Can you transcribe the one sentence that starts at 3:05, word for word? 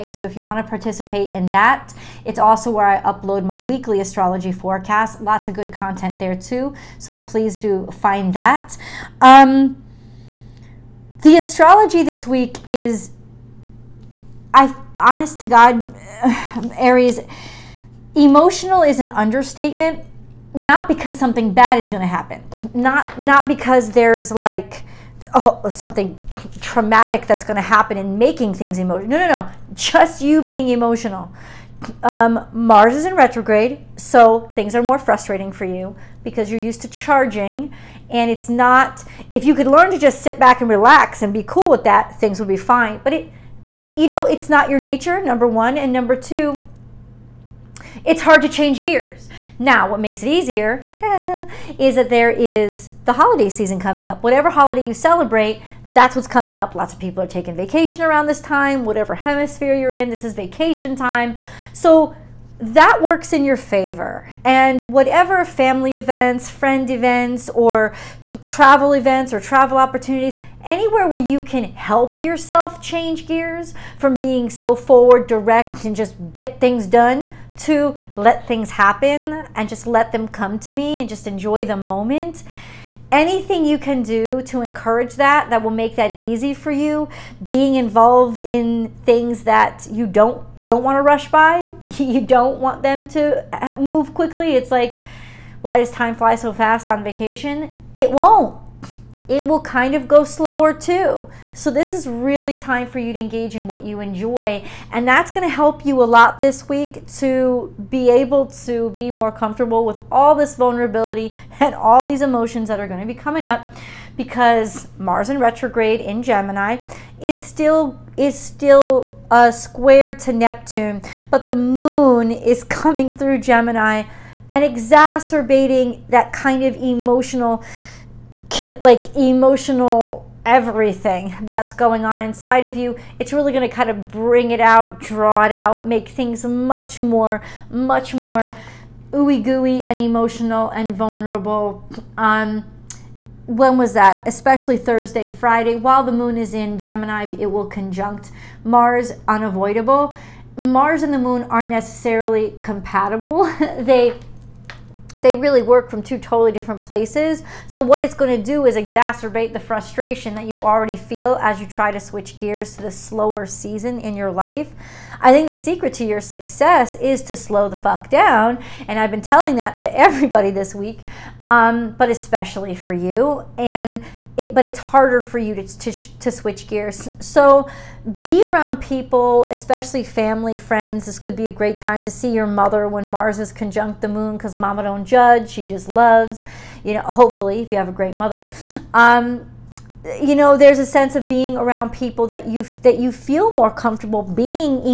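She just loves, you know, hopefully, if you have a great mother.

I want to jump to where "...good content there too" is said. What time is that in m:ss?
0:05.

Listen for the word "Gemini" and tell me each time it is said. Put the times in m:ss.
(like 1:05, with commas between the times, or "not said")
1:56, 2:03, 2:26.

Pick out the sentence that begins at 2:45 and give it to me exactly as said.
I think the secret to your success is to slow the fuck down.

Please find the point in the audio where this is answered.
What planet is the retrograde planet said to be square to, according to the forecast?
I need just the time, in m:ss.
2:00.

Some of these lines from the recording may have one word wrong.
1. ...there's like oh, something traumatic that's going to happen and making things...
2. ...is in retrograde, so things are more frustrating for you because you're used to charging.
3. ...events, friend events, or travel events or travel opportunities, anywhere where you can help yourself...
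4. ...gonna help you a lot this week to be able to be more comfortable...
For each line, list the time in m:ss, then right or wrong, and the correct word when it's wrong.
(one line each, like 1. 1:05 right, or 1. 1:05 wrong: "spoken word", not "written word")
1. 0:23 right
2. 0:32 right
3. 1:05 right
4. 1:45 right.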